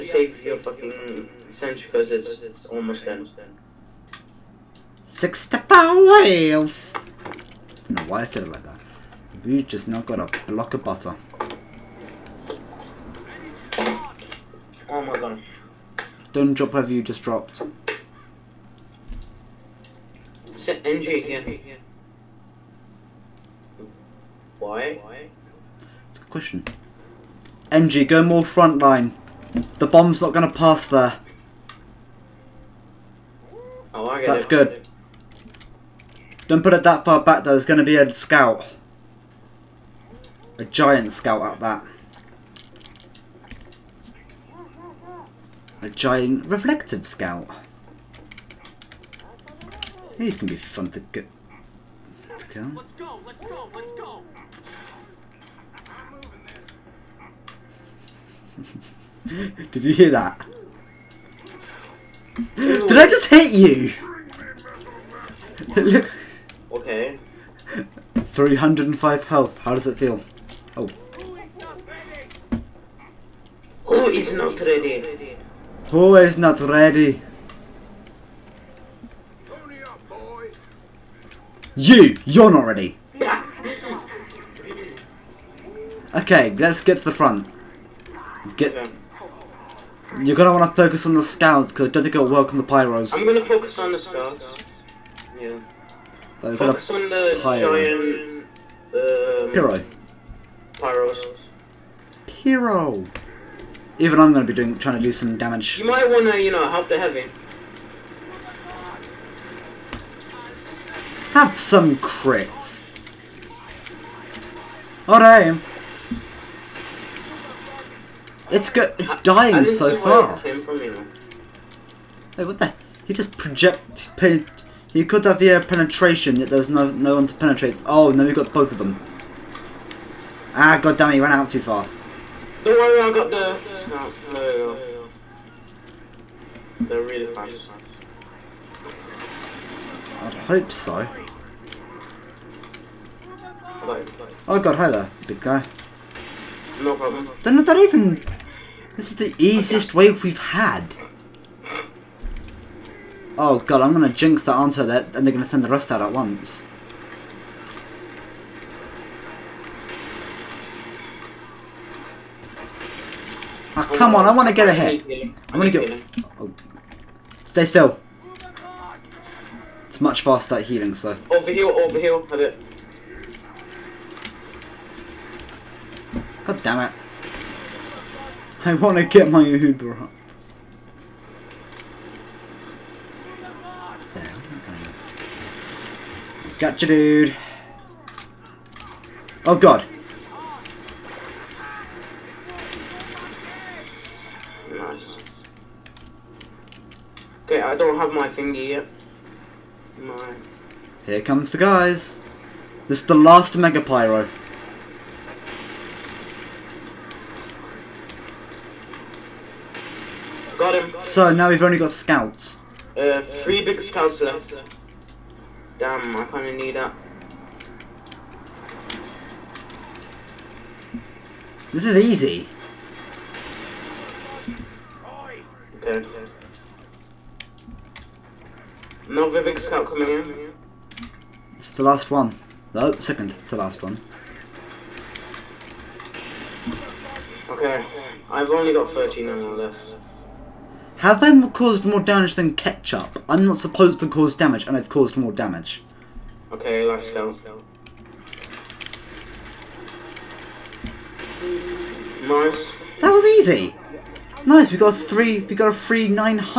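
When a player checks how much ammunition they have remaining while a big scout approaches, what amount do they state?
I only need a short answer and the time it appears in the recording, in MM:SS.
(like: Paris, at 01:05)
13, at 03:58.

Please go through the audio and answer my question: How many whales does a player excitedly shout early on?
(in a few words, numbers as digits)
65.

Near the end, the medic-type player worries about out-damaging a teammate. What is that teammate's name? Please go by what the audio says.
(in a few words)
Ketchup.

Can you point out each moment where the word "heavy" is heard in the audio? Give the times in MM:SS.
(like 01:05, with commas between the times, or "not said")
01:46.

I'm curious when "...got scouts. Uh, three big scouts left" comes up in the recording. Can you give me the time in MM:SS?
03:31.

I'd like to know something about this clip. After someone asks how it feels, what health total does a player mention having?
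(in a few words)
305.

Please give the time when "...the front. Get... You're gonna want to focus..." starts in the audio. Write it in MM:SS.
01:27.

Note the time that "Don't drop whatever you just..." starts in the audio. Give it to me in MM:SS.
00:16.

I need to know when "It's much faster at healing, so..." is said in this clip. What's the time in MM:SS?
02:49.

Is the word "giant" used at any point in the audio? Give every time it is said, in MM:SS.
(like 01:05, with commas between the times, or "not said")
00:40, 00:45, 01:37.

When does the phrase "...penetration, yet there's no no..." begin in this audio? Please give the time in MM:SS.
02:05.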